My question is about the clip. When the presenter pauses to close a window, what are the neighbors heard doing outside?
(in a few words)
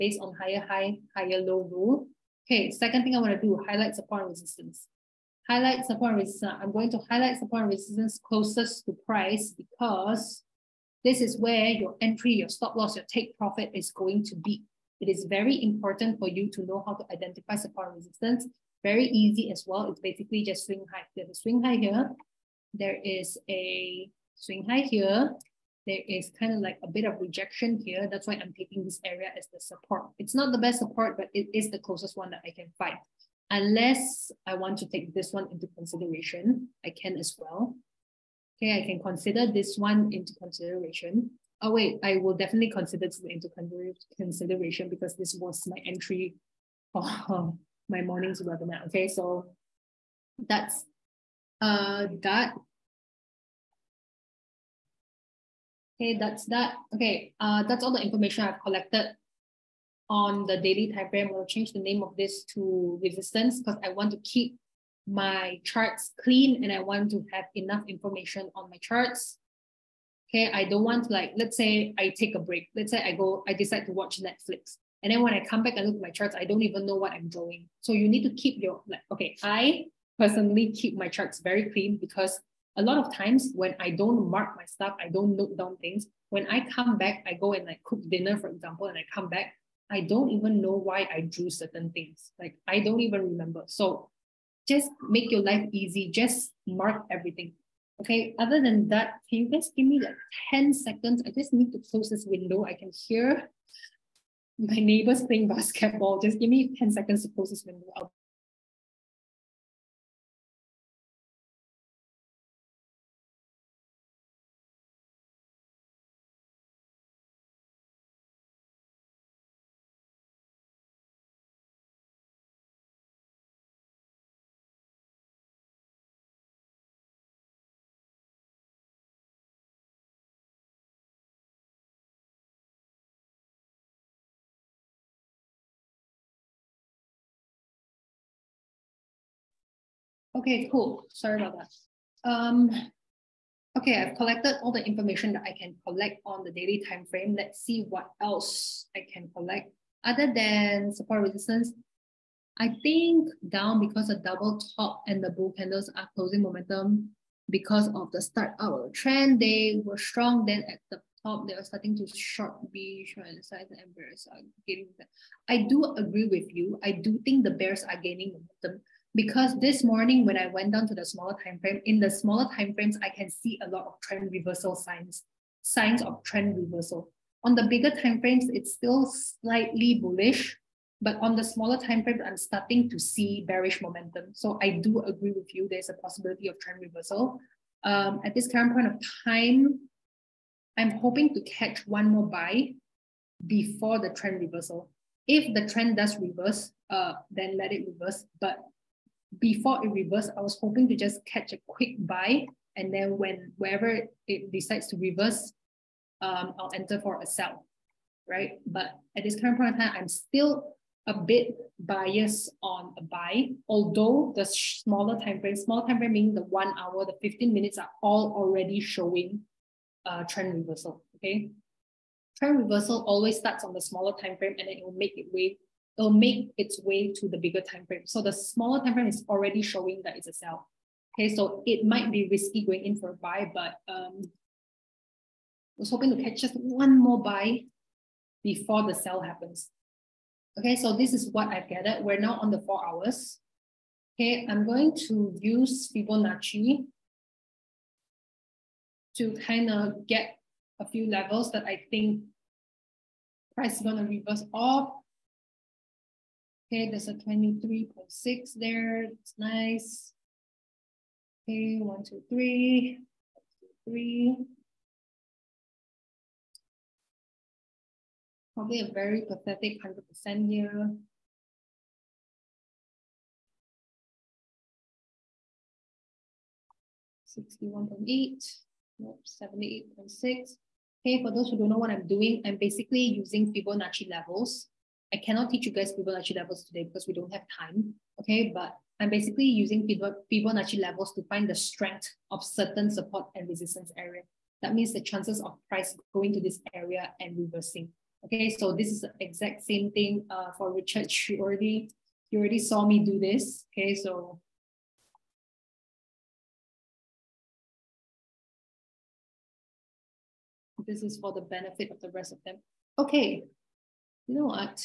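Playing basketball.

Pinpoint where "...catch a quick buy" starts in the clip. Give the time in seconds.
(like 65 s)
201 s.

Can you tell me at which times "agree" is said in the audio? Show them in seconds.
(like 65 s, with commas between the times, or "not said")
165 s, 184 s.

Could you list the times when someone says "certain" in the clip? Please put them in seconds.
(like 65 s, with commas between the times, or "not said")
91 s, 292 s.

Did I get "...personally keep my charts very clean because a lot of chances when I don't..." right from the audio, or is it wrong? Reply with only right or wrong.
wrong.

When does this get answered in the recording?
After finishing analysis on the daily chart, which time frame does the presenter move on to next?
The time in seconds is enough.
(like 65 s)
242 s.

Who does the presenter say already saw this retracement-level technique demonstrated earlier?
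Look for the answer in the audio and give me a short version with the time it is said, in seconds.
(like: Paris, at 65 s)
Richard, at 300 s.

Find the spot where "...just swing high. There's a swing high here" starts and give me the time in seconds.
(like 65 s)
20 s.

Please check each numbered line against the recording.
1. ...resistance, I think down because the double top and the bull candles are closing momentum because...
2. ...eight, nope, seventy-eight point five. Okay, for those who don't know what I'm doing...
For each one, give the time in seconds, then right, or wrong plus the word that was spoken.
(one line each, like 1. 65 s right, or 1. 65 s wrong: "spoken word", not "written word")
1. 151 s right
2. 278 s wrong: "six", not "five".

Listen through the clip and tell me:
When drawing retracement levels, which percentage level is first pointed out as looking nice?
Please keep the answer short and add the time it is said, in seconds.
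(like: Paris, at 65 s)
23.6, at 257 s.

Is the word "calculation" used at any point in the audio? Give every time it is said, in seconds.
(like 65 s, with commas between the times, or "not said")
not said.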